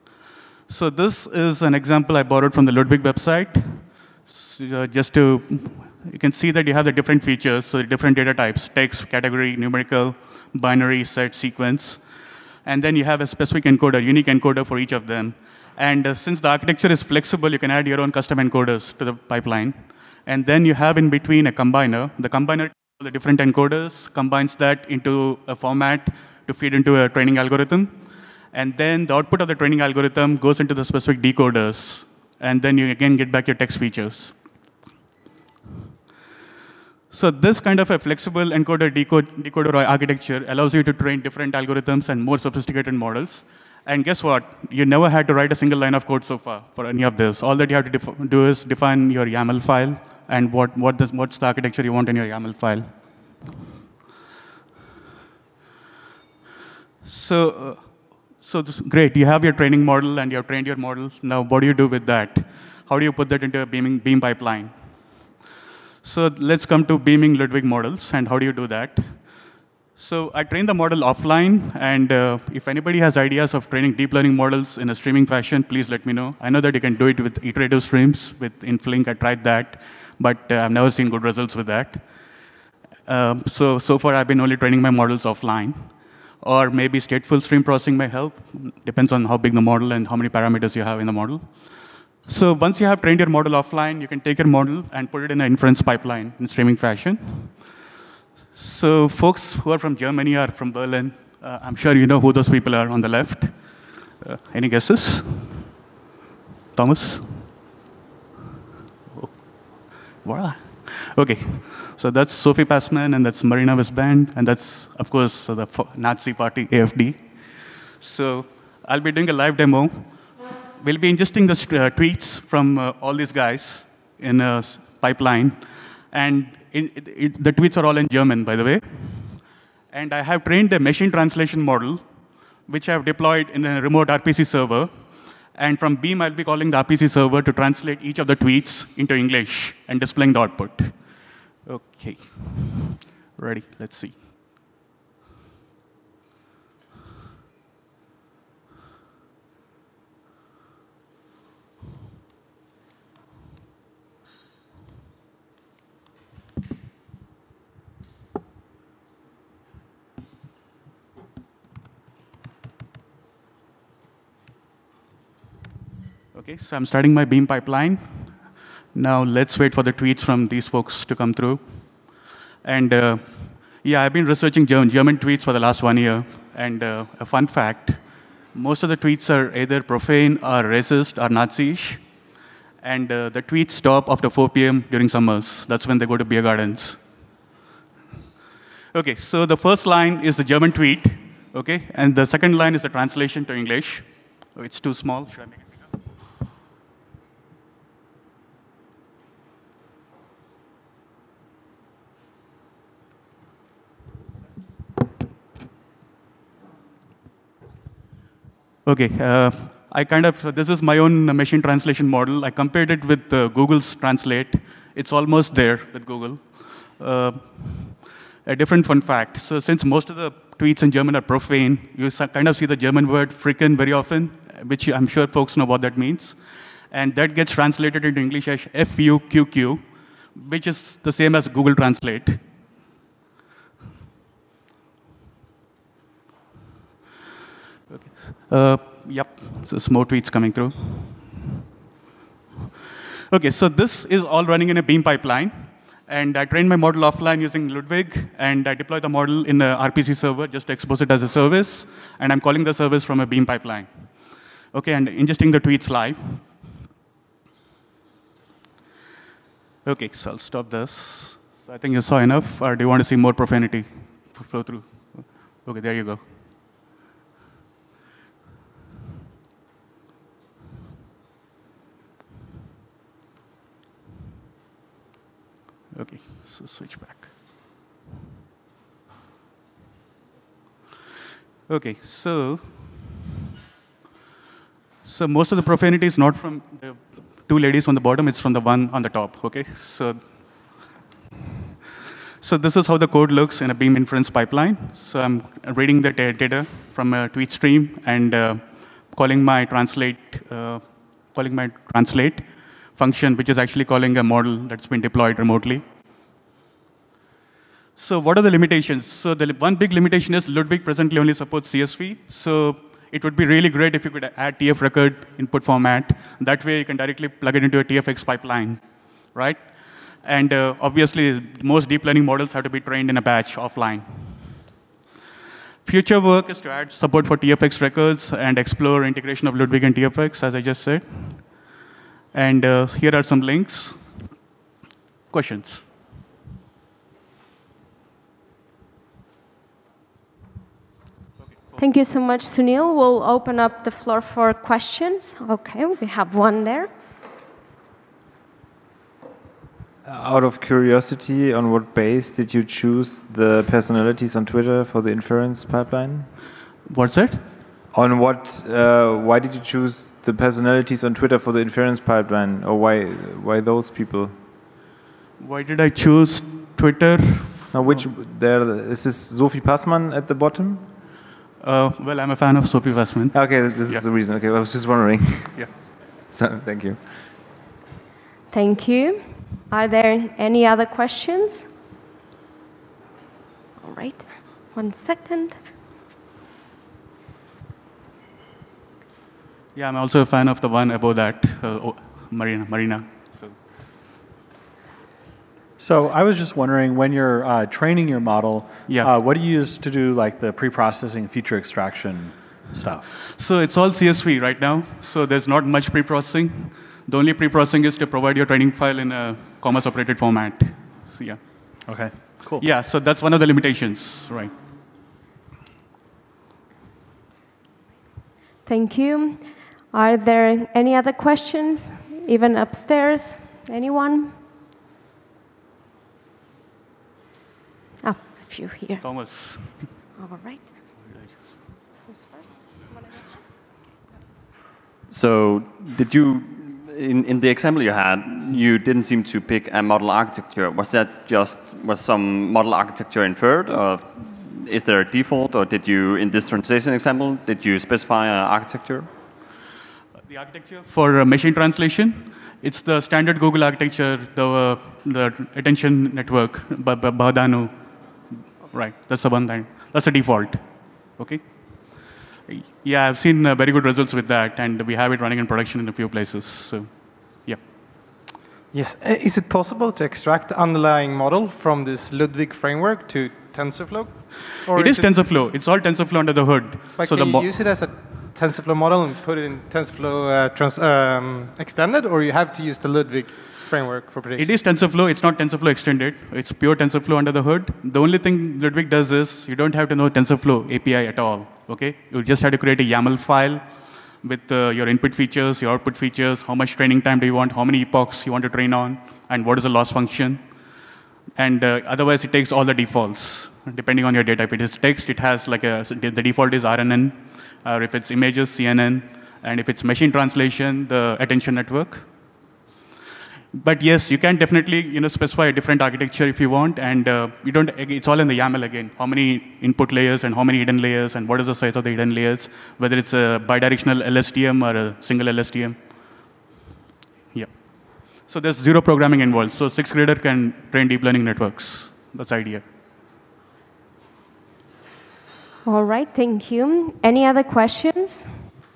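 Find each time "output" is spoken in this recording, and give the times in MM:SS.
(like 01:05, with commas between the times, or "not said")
00:29, 02:20, 08:15.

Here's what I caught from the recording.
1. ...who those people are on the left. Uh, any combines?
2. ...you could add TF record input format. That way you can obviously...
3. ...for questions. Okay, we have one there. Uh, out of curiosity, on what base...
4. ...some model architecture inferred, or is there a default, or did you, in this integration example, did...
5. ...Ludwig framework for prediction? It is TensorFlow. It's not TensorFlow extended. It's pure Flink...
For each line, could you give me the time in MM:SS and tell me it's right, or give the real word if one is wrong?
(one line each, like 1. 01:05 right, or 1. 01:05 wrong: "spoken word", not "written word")
1. 01:42 wrong: "guesses", not "combines"
2. 05:14 wrong: "directly", not "obviously"
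3. 05:44 right
4. 07:22 wrong: "translation", not "integration"
5. 08:02 wrong: "TensorFlow", not "Flink".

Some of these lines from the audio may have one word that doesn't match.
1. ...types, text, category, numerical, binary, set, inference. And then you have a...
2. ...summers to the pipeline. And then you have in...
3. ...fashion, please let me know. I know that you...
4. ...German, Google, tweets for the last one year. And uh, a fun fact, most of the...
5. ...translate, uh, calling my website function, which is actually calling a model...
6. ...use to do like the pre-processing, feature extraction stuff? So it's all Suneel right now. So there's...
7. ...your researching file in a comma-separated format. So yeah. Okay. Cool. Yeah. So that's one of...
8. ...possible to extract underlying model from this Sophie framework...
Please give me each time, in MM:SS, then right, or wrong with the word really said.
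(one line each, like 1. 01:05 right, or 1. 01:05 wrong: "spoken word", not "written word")
1. 00:08 wrong: "sequence", not "inference"
2. 00:18 wrong: "encoders", not "summers"
3. 01:15 right
4. 02:54 wrong: "German", not "Google"
5. 04:59 wrong: "translate", not "website"
6. 06:39 wrong: "CSV", not "Suneel"
7. 06:48 wrong: "training", not "researching"
8. 07:49 wrong: "Ludwig", not "Sophie".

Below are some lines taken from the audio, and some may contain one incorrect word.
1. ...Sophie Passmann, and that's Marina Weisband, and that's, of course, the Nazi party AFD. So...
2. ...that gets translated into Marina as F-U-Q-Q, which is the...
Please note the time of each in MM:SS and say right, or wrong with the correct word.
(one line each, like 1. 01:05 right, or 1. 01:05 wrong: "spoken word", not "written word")
1. 01:52 right
2. 03:47 wrong: "English", not "Marina".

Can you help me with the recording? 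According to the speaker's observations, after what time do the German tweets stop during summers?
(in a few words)
4 p.m.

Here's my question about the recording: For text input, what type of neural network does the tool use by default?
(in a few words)
RNN.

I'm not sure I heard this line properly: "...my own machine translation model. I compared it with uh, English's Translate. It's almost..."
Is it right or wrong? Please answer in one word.
wrong.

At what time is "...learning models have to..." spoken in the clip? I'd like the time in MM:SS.
05:22.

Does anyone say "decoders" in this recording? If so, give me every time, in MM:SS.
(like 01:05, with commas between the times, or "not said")
00:31, 00:38.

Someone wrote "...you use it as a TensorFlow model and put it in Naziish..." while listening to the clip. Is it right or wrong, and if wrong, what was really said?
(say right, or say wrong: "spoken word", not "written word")
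wrong: "TensorFlow", not "Naziish".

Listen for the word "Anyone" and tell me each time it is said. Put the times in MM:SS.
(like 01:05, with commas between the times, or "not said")
07:03.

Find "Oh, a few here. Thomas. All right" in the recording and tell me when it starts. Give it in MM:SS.
07:08.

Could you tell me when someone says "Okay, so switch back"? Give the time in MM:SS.
04:35.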